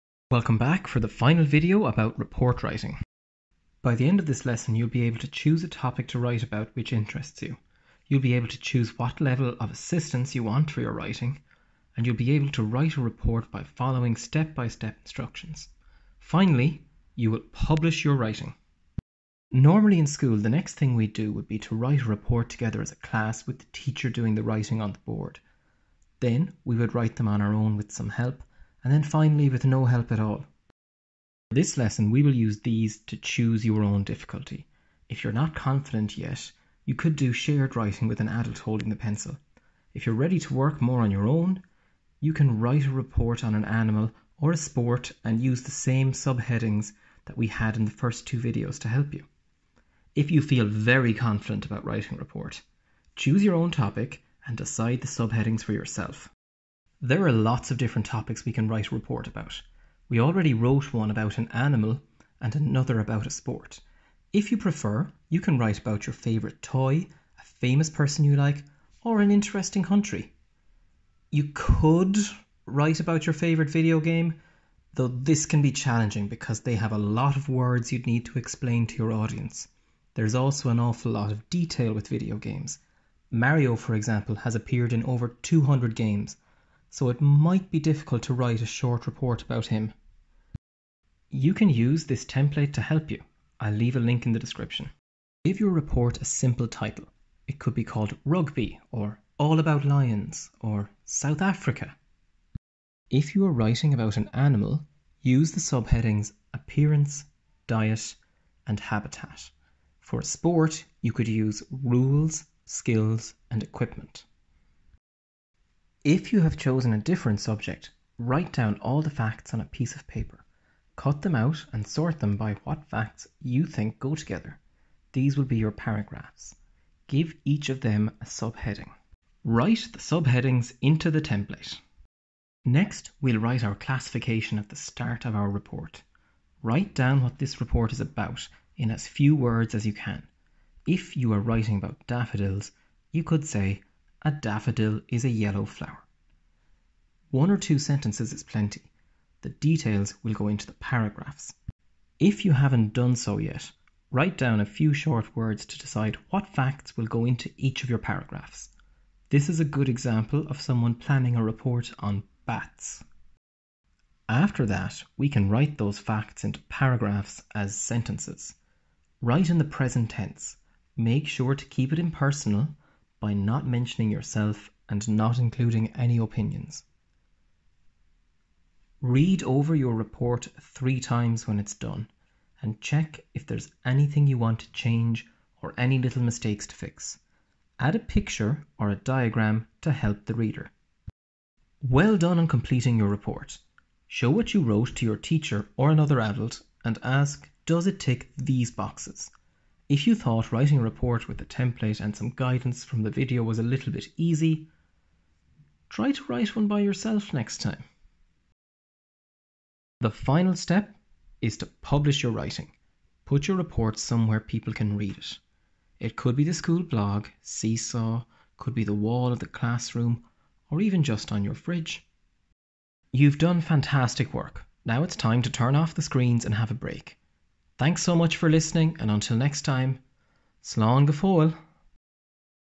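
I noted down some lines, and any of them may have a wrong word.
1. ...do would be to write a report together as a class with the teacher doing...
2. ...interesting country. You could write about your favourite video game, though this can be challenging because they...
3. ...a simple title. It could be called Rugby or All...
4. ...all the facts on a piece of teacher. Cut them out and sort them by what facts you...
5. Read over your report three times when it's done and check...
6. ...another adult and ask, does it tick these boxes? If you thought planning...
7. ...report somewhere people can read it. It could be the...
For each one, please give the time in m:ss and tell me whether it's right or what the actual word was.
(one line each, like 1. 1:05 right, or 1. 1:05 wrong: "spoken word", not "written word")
1. 0:21 right
2. 1:09 right
3. 1:36 right
4. 1:58 wrong: "paper", not "teacher"
5. 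2:58 right
6. 3:15 wrong: "writing", not "planning"
7. 3:33 right.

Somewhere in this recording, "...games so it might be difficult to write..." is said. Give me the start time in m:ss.
1:25.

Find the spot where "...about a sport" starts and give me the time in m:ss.
1:02.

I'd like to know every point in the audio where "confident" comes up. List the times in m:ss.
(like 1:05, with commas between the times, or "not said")
0:35, 0:51.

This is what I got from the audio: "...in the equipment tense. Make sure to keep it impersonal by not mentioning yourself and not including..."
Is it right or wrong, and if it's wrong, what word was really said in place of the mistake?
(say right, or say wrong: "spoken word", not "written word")
wrong: "present", not "equipment".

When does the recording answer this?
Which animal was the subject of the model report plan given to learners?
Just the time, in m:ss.
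2:42.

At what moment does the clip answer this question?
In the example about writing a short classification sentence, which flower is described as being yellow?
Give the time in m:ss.
2:22.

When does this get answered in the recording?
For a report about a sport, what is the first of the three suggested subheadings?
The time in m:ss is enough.
1:51.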